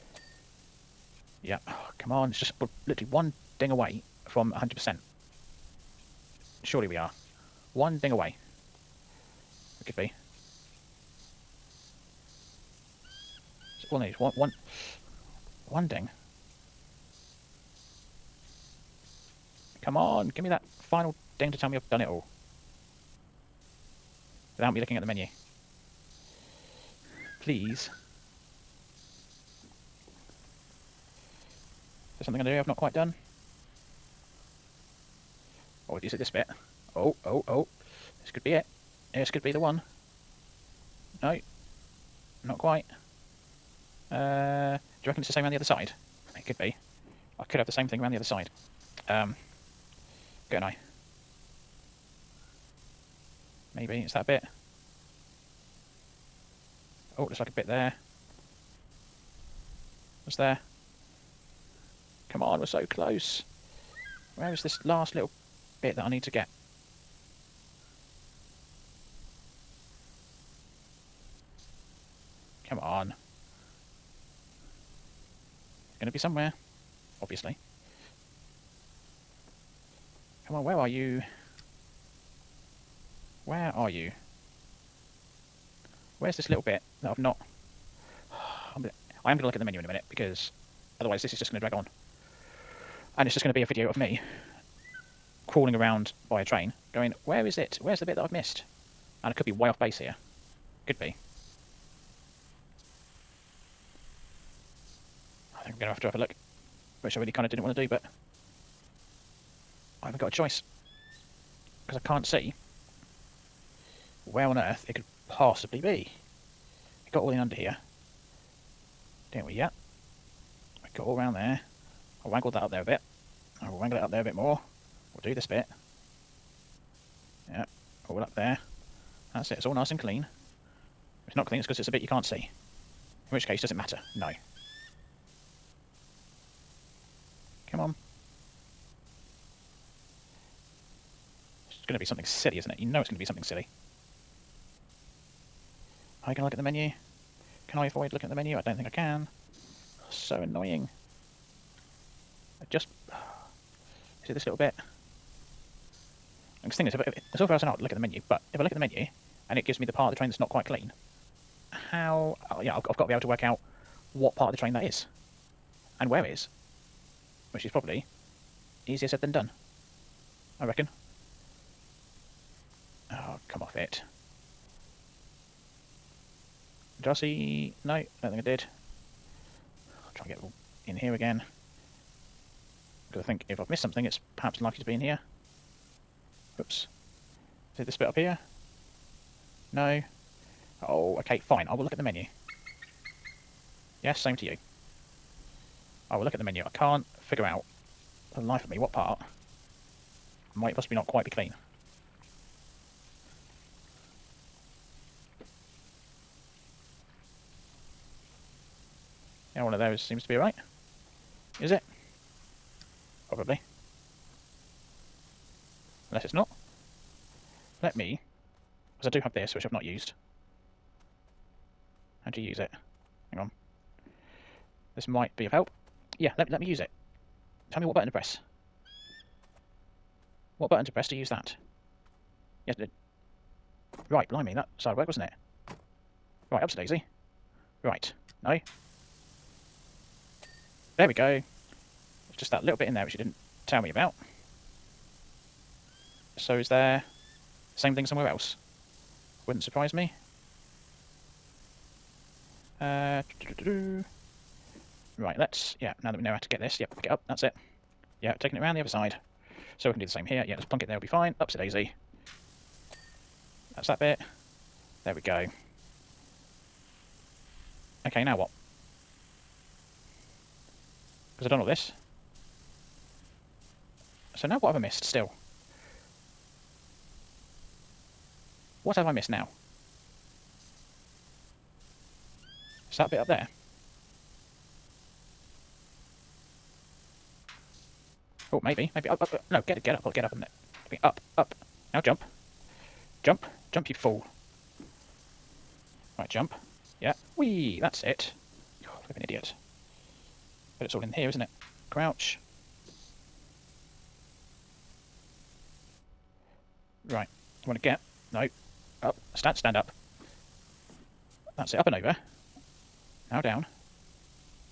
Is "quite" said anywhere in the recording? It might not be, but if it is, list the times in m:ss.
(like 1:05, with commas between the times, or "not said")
0:32, 0:42, 2:40, 3:21.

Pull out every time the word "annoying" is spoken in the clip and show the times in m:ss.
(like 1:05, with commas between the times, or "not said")
2:30.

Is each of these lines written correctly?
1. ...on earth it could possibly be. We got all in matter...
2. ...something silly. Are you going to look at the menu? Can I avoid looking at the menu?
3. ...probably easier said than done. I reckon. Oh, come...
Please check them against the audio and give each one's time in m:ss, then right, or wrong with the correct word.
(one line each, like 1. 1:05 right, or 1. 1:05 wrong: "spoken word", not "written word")
1. 1:54 wrong: "under", not "matter"
2. 2:23 right
3. 2:47 right.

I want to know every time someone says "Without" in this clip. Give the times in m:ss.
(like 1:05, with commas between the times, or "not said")
0:24.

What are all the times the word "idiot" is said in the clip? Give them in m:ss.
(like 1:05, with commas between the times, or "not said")
4:59.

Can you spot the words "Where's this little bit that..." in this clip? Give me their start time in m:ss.
1:26.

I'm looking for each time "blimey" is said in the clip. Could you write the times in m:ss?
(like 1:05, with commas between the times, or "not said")
3:54.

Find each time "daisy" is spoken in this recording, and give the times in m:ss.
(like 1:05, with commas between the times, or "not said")
3:56, 4:21.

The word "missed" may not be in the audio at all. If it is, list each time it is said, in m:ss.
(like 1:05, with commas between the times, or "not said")
1:38, 3:03, 4:34, 4:39.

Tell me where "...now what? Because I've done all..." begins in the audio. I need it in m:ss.
4:28.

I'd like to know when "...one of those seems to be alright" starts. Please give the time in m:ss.
3:29.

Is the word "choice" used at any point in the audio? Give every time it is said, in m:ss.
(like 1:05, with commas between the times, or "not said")
1:50.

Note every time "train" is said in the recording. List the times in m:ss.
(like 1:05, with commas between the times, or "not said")
1:36, 2:40, 2:44.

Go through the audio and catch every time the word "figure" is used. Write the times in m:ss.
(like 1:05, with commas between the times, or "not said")
3:17.